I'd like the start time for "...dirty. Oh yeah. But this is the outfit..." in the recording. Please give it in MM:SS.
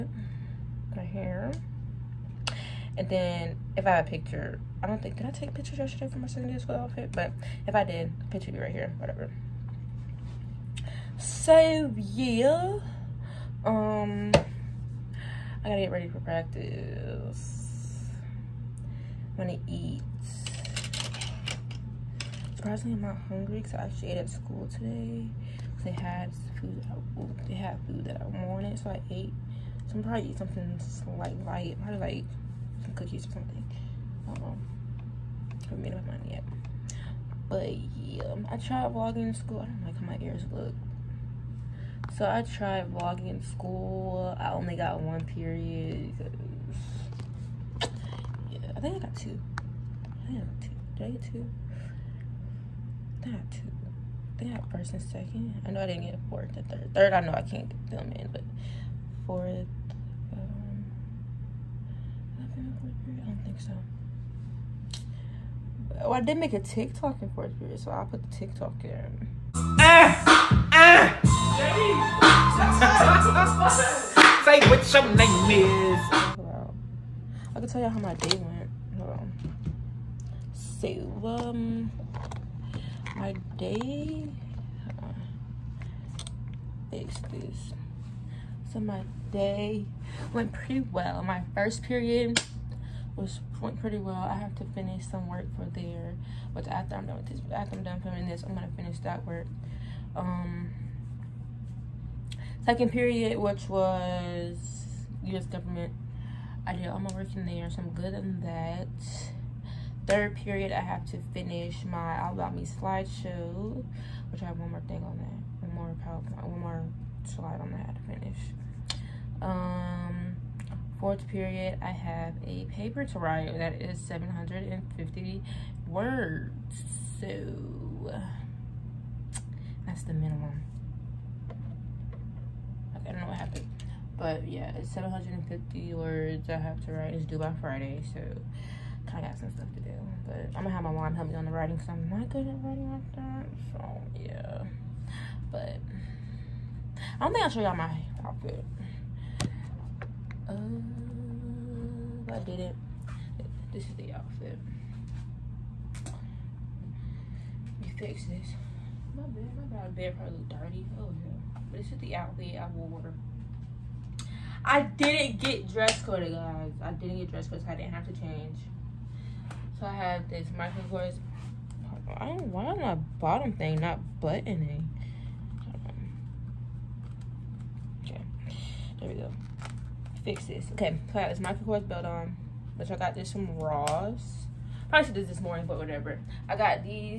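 02:40.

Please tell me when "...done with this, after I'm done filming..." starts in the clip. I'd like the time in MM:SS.
01:37.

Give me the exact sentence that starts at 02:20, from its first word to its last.
But I'm gonna have my mom help me on the writing, because I'm not good at writing like that.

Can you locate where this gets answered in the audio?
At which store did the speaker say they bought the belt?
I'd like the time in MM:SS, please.
03:03.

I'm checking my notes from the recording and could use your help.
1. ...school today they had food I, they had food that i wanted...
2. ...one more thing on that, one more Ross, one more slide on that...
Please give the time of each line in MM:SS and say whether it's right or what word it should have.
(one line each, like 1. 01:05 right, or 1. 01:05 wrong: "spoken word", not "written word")
1. 00:24 right
2. 01:54 wrong: "PowerPoint", not "Ross".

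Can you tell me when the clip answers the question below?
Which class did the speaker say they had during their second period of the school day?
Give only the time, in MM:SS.
01:45.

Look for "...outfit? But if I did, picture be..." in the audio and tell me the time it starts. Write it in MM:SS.
00:06.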